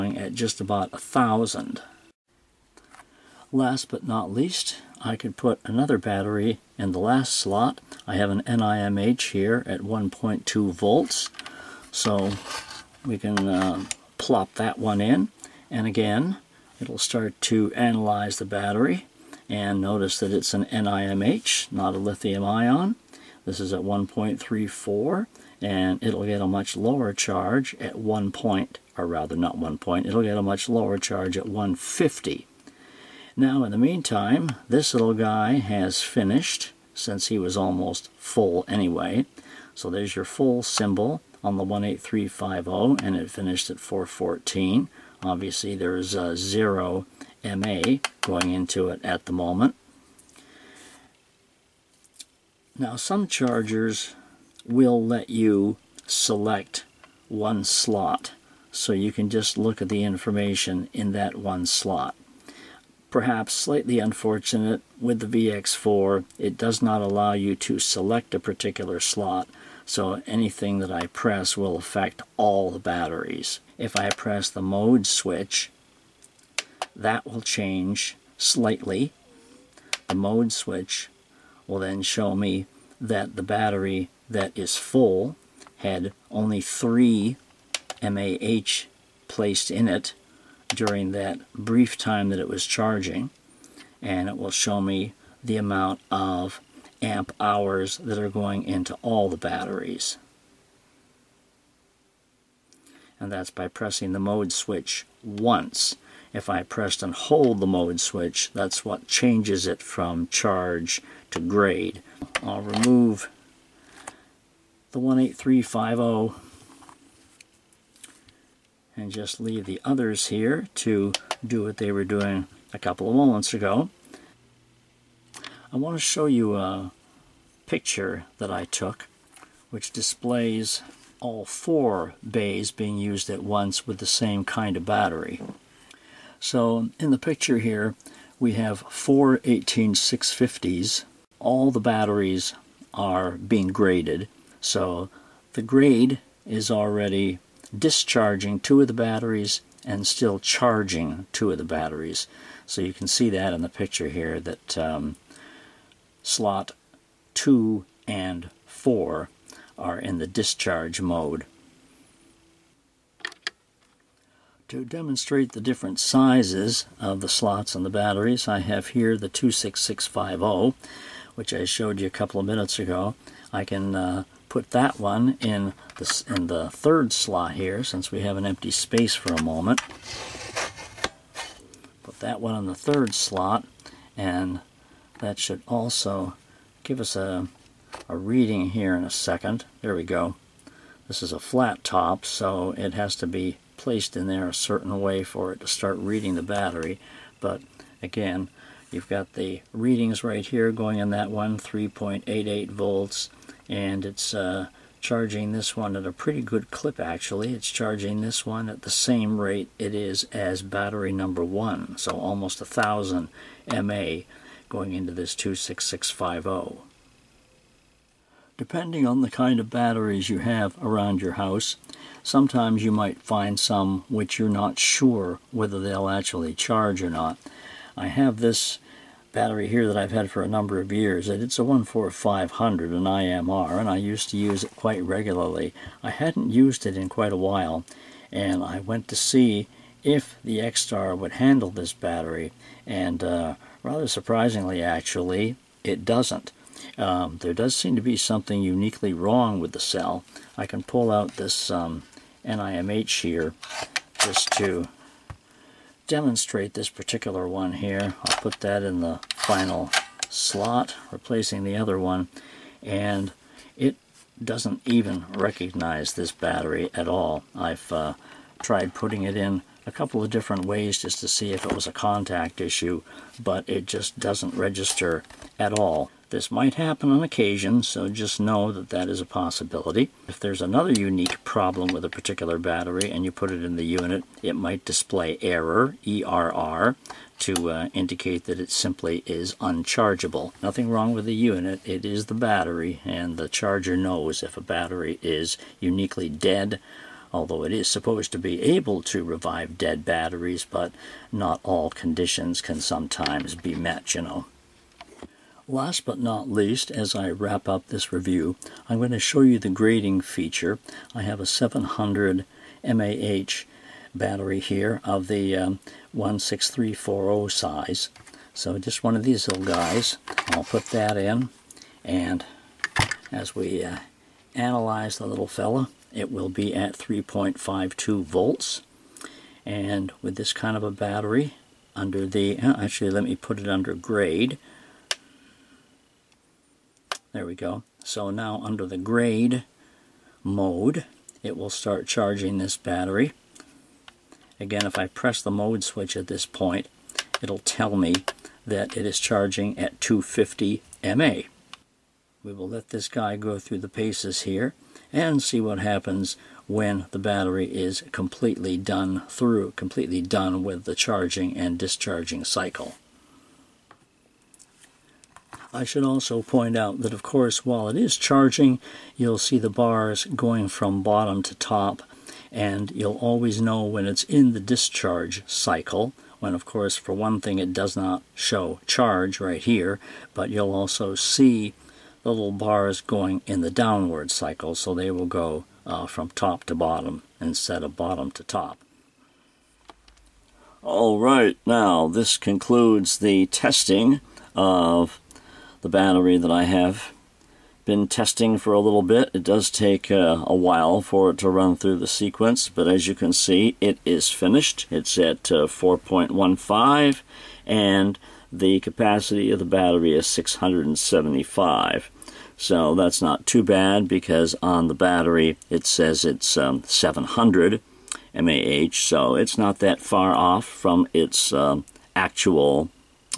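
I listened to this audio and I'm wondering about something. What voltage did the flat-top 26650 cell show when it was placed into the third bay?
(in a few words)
3.88 volts.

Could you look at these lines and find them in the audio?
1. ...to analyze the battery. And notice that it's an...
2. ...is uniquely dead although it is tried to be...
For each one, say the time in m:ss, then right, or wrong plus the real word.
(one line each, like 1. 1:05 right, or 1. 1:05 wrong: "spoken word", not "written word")
1. 0:17 right
2. 4:55 wrong: "supposed", not "tried".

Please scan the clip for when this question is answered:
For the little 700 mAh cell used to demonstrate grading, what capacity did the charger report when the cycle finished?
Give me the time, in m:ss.
6:50.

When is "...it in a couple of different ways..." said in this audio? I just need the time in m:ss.
4:29.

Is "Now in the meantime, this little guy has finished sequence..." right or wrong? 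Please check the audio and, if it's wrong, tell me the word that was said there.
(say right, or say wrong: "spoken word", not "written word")
wrong: "since", not "sequence".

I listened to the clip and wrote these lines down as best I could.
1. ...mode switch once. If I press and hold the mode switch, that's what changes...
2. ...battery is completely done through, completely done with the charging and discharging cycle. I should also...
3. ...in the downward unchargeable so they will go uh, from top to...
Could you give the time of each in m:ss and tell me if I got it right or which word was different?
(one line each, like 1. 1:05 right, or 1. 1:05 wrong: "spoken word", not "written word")
1. 1:44 right
2. 5:57 right
3. 6:23 wrong: "cycle", not "unchargeable".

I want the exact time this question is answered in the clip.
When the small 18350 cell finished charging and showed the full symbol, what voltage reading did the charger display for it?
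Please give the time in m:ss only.
0:43.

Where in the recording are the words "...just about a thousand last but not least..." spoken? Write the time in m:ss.
0:00.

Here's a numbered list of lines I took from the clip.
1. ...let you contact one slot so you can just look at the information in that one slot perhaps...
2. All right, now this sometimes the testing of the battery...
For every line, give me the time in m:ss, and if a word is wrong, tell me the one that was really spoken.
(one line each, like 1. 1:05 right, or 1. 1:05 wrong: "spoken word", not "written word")
1. 0:55 wrong: "select", not "contact"
2. 6:30 wrong: "concludes", not "sometimes".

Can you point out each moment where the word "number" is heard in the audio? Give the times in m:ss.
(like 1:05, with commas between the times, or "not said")
3:31, 3:50.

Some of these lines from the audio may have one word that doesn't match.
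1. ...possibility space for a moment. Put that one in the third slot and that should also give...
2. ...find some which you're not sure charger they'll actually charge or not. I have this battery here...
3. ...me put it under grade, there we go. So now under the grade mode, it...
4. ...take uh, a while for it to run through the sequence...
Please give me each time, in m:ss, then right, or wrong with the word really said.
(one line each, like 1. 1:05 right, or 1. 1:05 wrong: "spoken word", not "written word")
1. 2:58 wrong: "empty", not "possibility"
2. 3:43 wrong: "whether", not "charger"
3. 5:33 right
4. 6:39 right.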